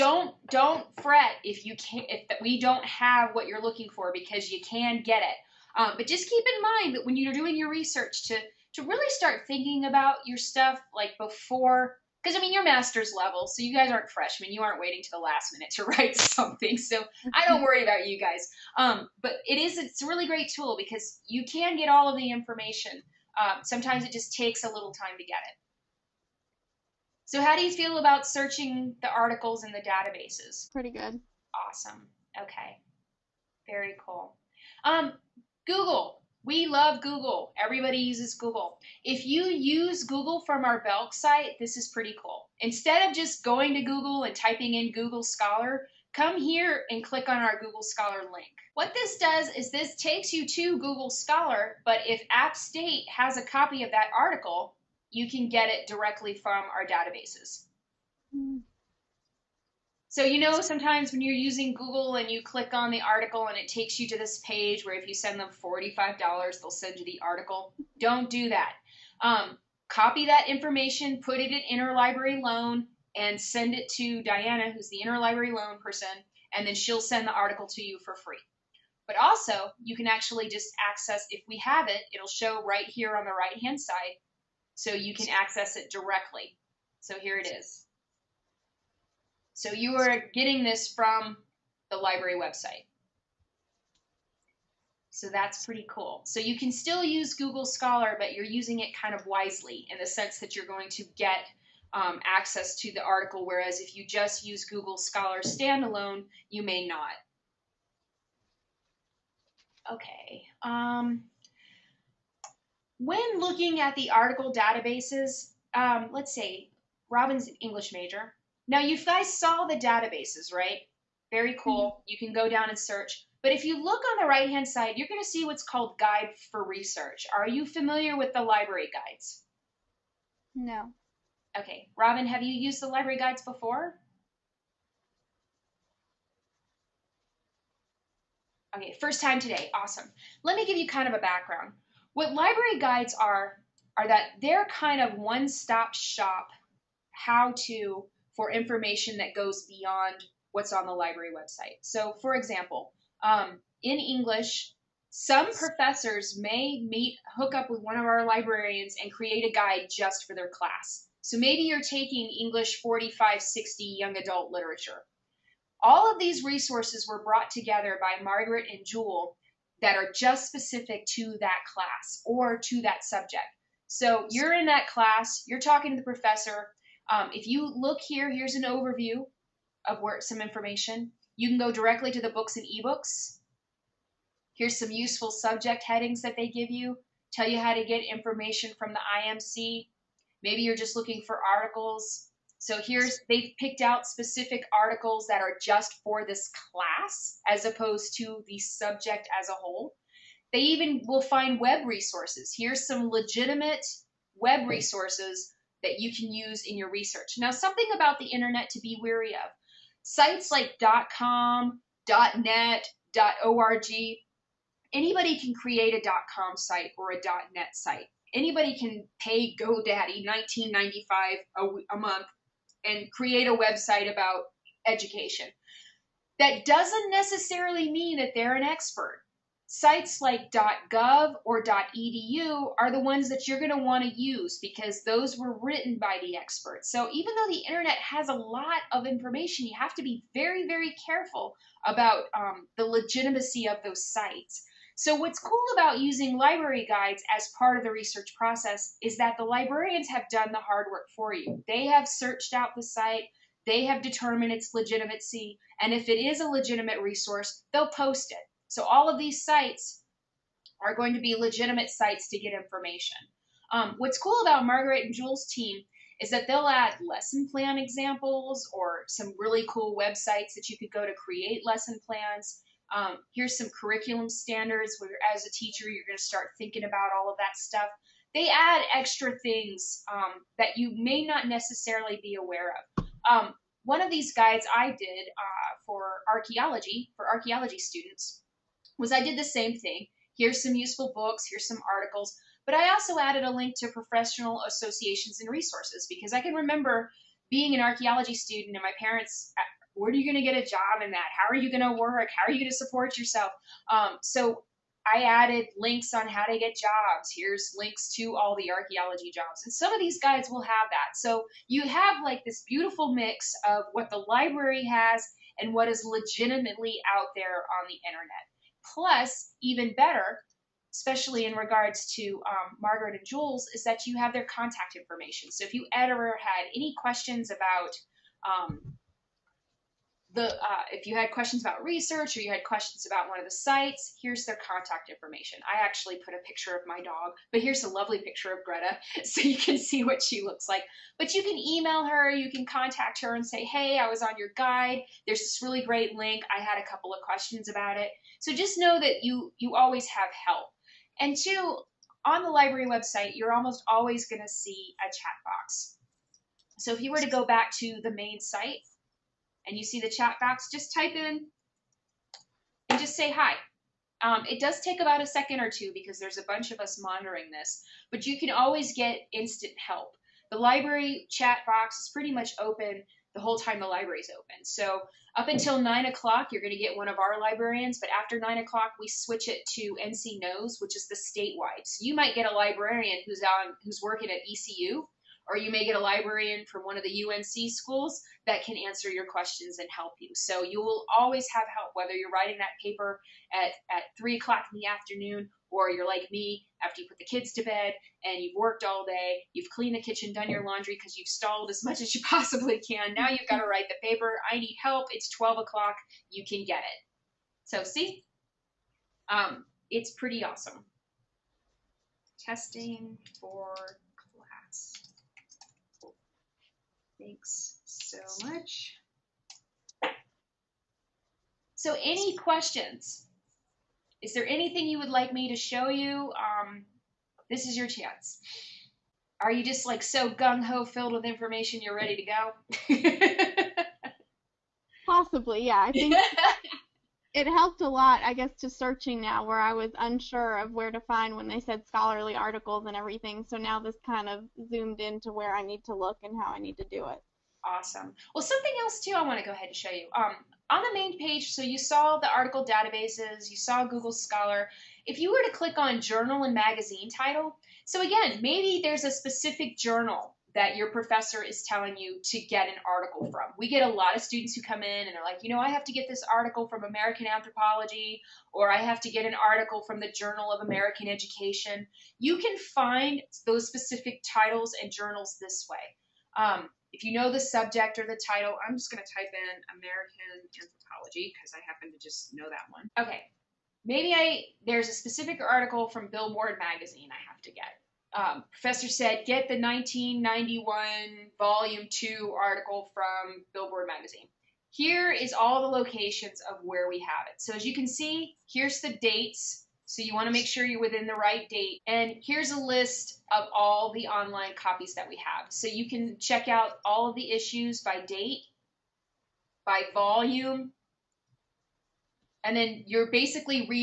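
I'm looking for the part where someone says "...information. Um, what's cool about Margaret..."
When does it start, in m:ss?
4:22.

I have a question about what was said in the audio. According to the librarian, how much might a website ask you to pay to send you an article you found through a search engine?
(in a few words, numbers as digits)
$45.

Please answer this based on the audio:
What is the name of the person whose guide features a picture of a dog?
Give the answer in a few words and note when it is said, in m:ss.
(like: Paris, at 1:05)
Greta, at 5:38.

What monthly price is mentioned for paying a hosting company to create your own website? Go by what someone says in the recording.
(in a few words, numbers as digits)
19.95.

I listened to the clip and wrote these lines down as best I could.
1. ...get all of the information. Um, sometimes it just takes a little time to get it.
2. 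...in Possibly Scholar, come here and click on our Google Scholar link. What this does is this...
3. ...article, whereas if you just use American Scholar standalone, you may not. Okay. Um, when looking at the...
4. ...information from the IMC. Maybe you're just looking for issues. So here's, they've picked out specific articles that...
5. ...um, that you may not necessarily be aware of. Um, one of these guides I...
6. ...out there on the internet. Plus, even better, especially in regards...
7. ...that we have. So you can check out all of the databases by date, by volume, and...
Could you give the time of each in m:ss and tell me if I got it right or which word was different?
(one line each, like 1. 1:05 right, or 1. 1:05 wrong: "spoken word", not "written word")
1. 0:21 right
2. 0:44 wrong: "Google", not "Possibly"
3. 1:43 wrong: "Google", not "American"
4. 3:08 wrong: "articles", not "issues"
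5. 4:40 right
6. 5:17 right
7. 8:24 wrong: "issues", not "databases".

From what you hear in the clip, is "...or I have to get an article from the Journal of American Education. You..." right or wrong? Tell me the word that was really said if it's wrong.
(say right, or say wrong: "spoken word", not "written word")
right.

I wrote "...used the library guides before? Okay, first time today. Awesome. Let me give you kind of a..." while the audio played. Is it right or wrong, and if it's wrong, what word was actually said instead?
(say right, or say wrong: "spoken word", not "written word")
right.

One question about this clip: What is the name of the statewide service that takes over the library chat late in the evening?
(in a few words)
NC Knows.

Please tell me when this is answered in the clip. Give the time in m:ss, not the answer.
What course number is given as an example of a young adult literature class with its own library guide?
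2:42.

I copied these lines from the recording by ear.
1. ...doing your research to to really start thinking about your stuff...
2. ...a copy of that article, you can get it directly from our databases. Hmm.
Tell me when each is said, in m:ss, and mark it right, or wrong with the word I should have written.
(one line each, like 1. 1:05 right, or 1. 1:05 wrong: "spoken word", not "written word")
1. 0:07 right
2. 0:53 right.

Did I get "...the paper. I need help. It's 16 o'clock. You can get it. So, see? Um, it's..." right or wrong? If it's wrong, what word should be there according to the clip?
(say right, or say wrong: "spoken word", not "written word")
wrong: "12", not "16".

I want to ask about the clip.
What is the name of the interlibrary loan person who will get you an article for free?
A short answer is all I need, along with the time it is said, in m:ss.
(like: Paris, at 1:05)
Diana, at 1:14.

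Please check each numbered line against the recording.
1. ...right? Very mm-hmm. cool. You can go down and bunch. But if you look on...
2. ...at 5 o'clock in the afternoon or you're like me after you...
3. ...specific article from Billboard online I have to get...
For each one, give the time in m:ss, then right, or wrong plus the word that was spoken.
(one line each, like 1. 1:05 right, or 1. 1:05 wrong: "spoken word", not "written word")
1. 2:00 wrong: "search", not "bunch"
2. 6:33 wrong: "3", not "5"
3. 8:04 wrong: "magazine", not "online".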